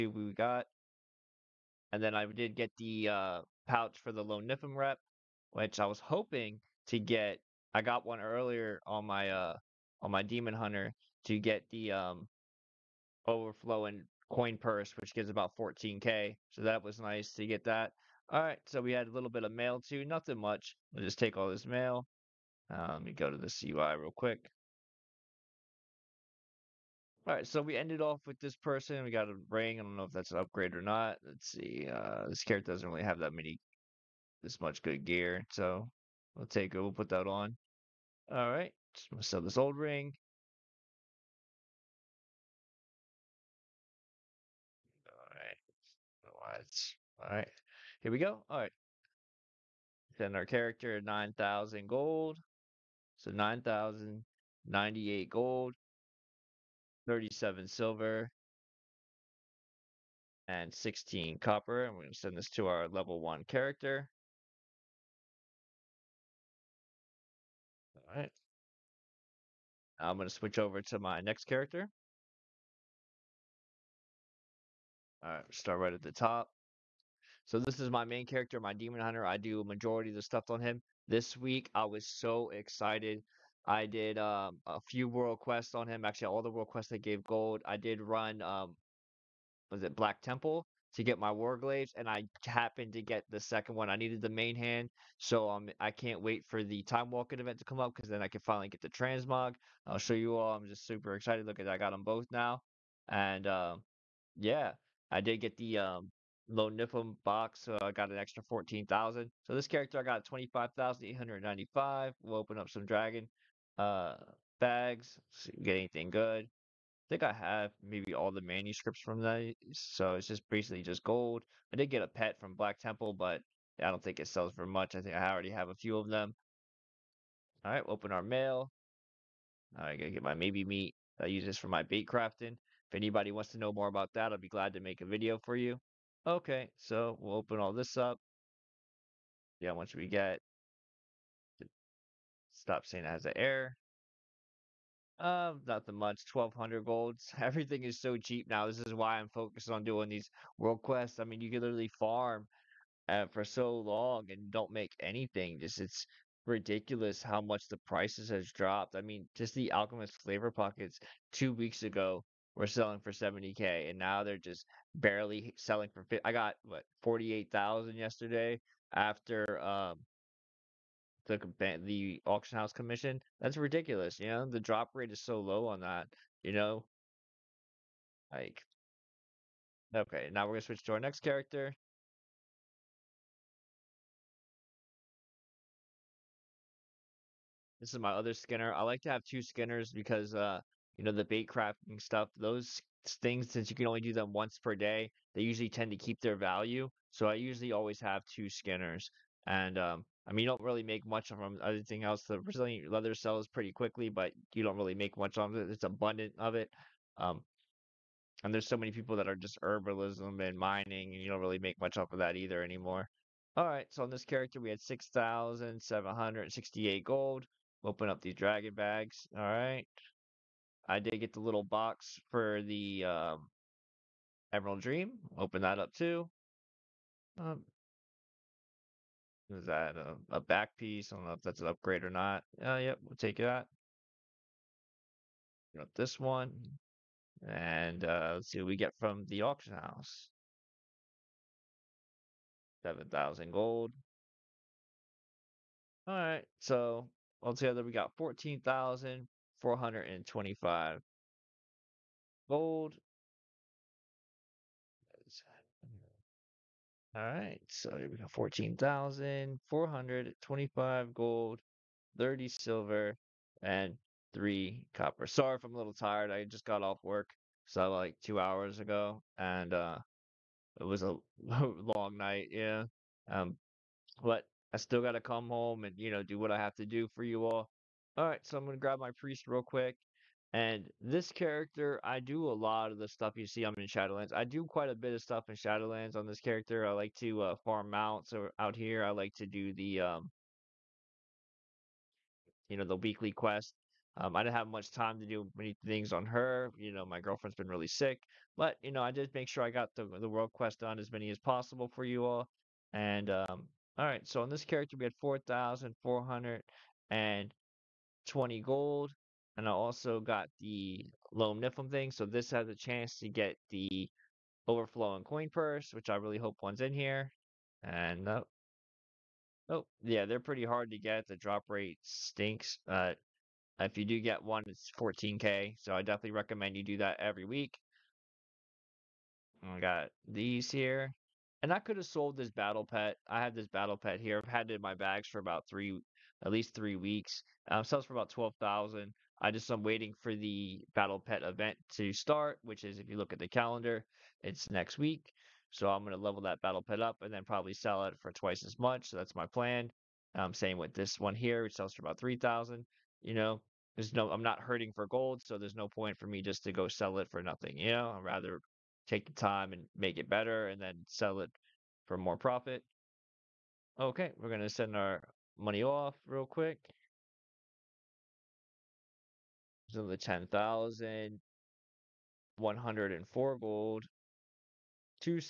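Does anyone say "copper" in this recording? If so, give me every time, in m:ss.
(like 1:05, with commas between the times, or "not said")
1:01, 4:24.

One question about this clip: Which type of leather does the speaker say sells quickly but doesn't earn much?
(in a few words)
Resilient leather.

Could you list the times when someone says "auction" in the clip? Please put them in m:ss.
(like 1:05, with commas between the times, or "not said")
2:52, 3:59.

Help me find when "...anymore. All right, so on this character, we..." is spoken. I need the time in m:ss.
3:32.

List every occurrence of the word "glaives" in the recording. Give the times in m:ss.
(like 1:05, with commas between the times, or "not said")
1:31.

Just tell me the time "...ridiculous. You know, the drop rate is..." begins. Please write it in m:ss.
2:53.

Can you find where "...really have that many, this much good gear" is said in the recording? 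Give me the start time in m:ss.
0:32.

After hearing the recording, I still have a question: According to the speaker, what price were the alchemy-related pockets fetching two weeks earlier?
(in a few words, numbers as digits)
70k.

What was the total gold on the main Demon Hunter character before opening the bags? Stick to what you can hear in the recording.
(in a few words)
25,895.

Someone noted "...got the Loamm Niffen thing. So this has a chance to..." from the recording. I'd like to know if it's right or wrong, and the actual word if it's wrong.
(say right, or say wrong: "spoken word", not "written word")
right.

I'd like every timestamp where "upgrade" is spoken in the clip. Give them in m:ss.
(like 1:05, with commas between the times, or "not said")
0:30, 3:51.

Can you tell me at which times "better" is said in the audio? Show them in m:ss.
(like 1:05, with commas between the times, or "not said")
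6:00.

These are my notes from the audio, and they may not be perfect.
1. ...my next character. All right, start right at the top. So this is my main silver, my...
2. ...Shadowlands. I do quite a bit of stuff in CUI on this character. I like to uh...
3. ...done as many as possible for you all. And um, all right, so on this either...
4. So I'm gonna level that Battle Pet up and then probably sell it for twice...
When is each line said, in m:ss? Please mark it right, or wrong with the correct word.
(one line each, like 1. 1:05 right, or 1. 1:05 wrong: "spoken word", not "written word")
1. 1:10 wrong: "character", not "silver"
2. 4:43 wrong: "Shadowlands", not "CUI"
3. 5:00 wrong: "character", not "either"
4. 5:45 right.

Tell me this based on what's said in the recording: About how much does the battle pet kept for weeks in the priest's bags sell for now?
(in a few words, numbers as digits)
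12,000.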